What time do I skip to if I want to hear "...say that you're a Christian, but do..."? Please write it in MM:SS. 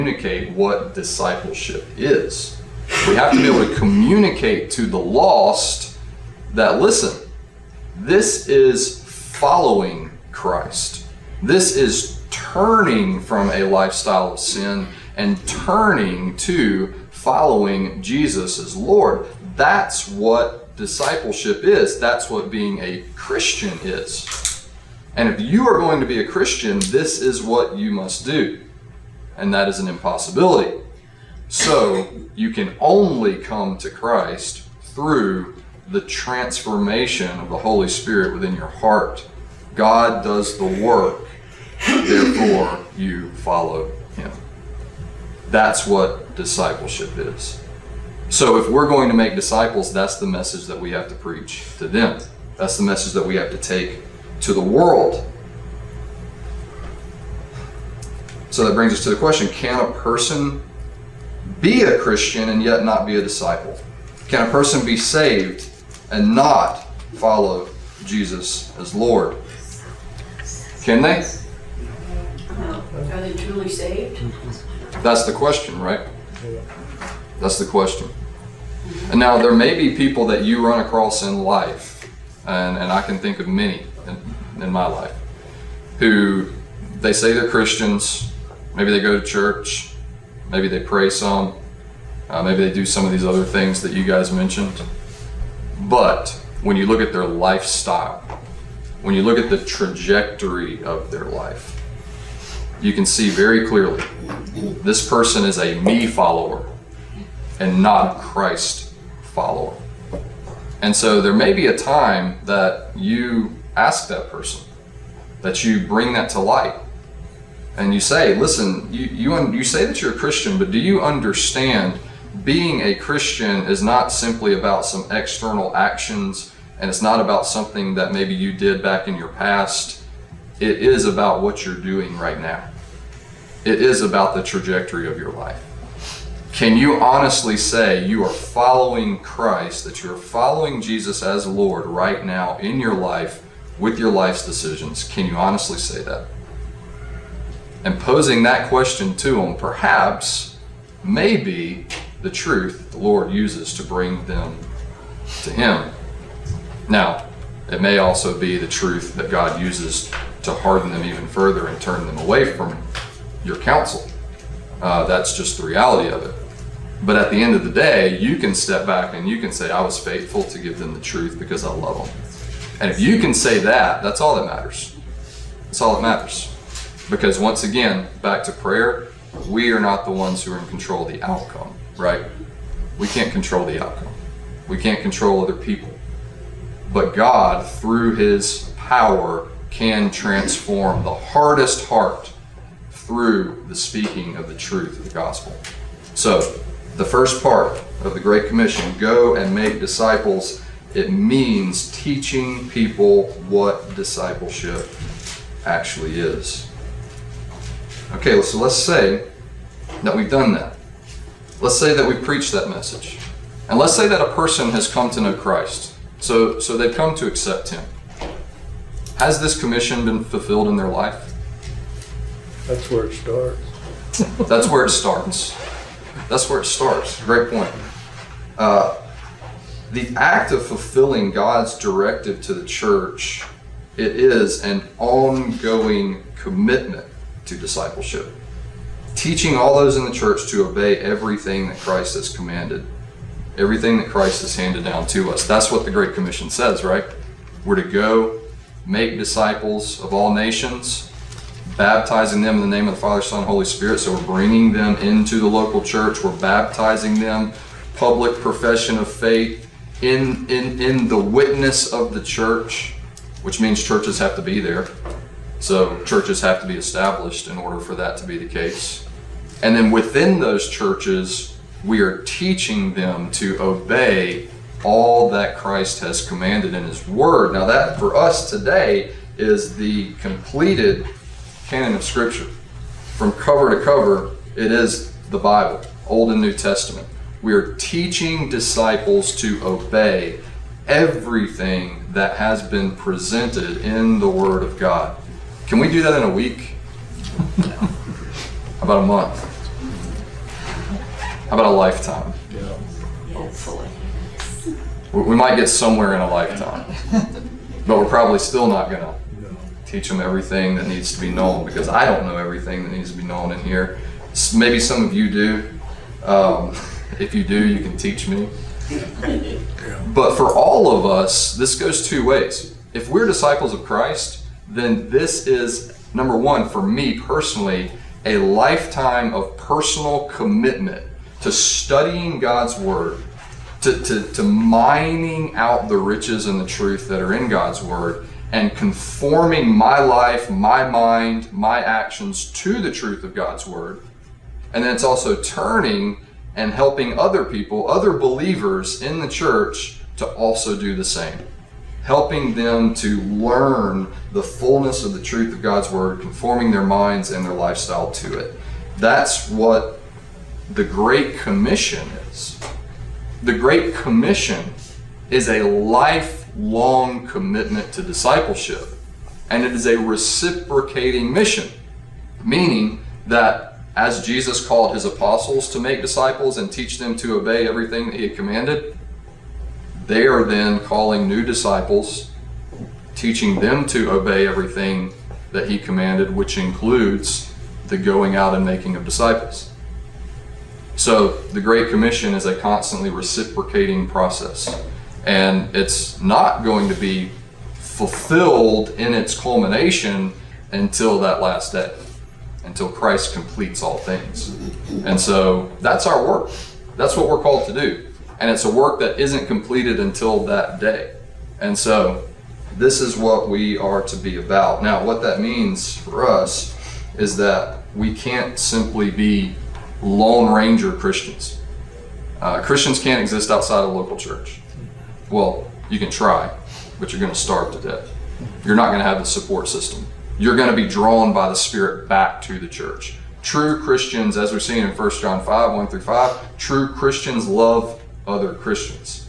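01:59.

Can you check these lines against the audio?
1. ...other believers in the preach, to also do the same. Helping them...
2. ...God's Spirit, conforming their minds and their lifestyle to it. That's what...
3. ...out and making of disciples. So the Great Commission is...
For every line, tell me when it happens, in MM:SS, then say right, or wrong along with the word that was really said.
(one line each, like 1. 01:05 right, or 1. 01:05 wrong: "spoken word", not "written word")
1. 05:47 wrong: "church", not "preach"
2. 05:55 wrong: "Word", not "Spirit"
3. 06:28 right.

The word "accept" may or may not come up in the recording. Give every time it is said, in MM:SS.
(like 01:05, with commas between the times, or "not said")
03:37.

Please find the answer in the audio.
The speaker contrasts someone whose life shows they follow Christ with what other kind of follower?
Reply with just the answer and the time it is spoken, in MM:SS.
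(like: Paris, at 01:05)
me follower, at 01:45.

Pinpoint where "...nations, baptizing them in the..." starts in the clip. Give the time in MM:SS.
04:10.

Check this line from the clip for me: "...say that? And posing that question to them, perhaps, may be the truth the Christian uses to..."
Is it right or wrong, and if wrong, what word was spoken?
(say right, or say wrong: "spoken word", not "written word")
wrong: "Lord", not "Christian".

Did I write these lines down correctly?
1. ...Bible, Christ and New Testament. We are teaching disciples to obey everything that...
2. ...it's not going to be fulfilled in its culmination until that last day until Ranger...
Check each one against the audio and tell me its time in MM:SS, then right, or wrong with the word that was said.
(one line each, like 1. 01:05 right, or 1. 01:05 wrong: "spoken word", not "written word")
1. 04:45 wrong: "Old", not "Christ"
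2. 06:35 wrong: "Christ", not "Ranger".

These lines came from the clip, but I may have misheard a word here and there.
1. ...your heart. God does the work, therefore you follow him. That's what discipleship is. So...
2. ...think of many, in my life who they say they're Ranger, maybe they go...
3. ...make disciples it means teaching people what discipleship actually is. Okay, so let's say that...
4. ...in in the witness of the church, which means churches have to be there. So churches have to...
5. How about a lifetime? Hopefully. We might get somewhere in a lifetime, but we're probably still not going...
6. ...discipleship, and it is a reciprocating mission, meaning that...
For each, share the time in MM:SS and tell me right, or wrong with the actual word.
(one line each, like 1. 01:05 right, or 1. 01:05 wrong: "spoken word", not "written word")
1. 00:38 right
2. 01:23 wrong: "Christians", not "Ranger"
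3. 03:19 right
4. 04:20 right
5. 05:01 right
6. 06:08 right.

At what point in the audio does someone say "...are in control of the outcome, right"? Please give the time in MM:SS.
03:00.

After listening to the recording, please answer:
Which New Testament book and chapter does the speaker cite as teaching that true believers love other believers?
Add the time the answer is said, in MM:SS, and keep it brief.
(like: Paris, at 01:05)
1 John 5, at 07:14.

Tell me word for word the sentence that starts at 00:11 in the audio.
This is turning from a lifestyle of sin and turning to following Jesus as Lord.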